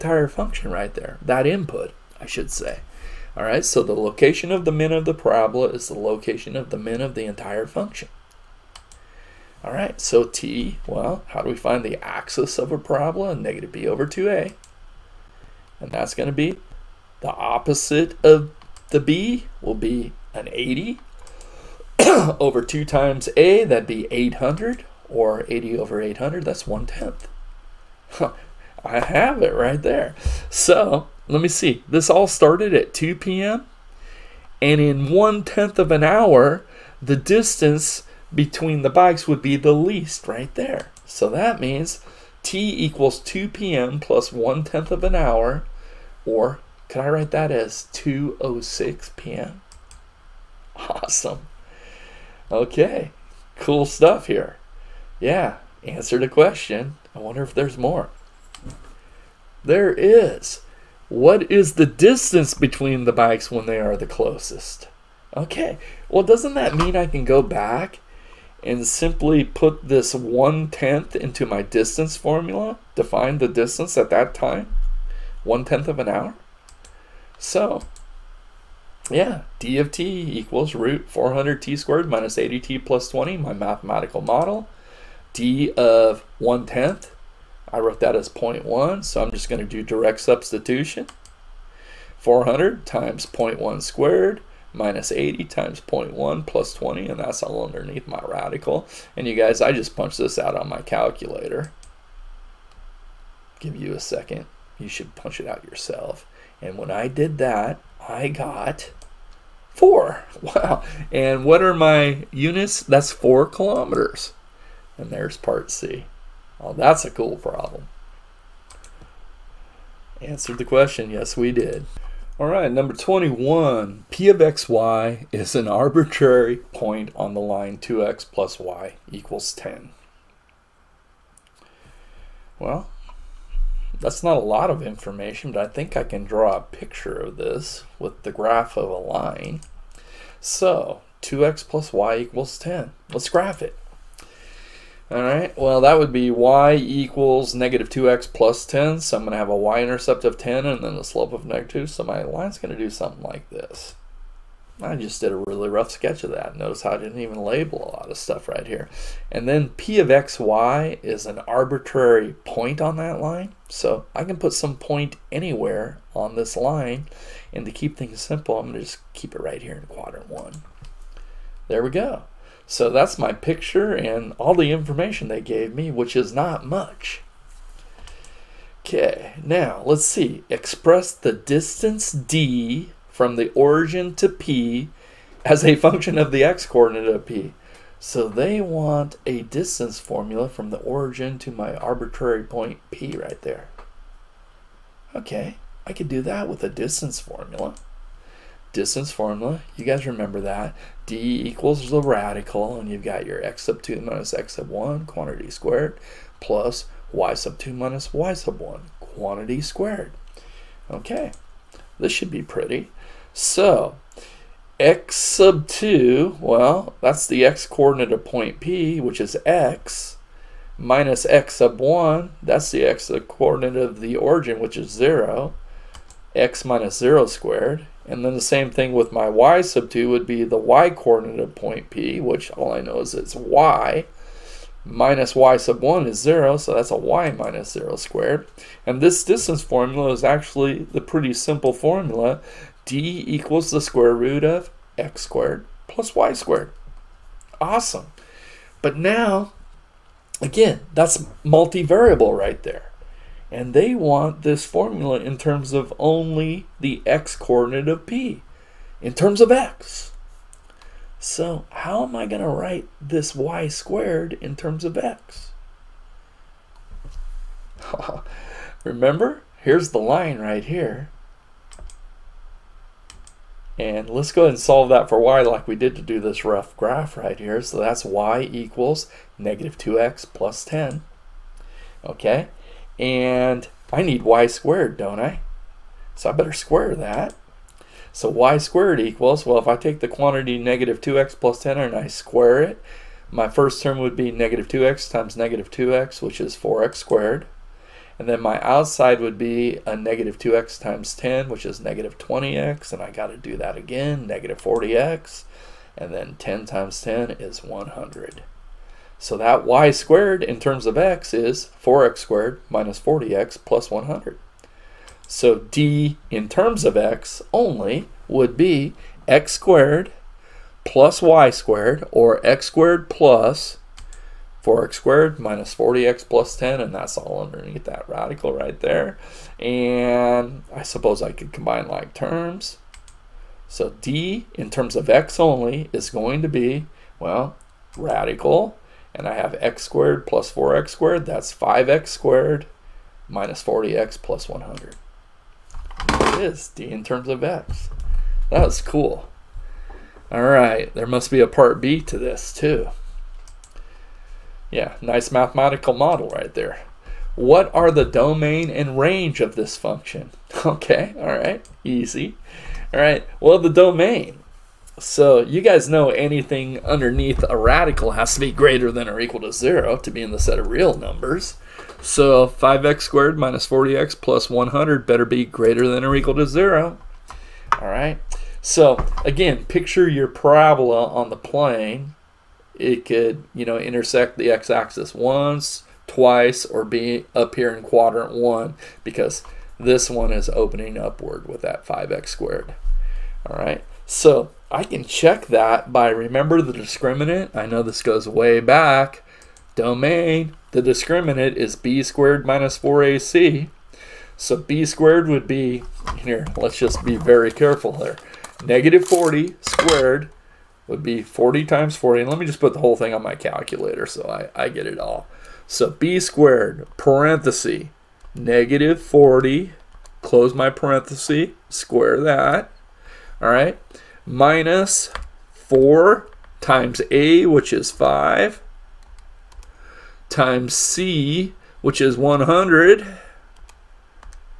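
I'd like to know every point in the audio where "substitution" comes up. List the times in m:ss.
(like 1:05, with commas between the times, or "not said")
1:30.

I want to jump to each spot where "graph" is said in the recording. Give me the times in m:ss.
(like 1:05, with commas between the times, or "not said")
2:18, 2:23, 4:36.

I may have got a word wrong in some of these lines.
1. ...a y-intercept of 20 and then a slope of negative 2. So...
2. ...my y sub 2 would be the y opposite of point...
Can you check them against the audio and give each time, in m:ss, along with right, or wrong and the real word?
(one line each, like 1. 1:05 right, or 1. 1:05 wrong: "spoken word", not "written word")
1. 2:29 wrong: "10", not "20"
2. 3:49 wrong: "coordinate", not "opposite".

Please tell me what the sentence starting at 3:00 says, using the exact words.
Express the distance d from the origin to p as a function of the x-coordinate of p.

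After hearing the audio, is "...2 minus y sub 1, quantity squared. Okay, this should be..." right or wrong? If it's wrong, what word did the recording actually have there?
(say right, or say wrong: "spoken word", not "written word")
right.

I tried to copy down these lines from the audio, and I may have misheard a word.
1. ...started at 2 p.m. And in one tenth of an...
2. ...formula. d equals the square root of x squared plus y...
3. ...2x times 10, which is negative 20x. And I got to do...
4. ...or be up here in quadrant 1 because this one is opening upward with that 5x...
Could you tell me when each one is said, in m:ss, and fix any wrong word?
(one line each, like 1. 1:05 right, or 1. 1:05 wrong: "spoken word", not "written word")
1. 0:32 right
2. 4:01 right
3. 5:00 right
4. 6:26 right.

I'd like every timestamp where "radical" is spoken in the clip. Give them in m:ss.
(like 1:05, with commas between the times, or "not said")
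1:38, 3:22, 5:28, 5:37, 6:07.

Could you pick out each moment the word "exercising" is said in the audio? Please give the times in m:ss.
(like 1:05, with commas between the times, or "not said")
not said.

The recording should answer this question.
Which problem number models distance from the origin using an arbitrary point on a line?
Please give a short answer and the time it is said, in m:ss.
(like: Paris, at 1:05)
21, at 2:02.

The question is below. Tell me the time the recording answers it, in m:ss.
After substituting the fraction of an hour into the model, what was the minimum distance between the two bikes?
1:53.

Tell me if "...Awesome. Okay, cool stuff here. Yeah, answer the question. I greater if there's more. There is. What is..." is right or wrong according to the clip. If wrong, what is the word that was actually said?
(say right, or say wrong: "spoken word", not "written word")
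wrong: "wonder", not "greater".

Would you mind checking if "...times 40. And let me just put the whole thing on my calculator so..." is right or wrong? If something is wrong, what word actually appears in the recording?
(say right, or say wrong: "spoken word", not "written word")
right.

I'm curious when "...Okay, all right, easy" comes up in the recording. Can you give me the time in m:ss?
6:00.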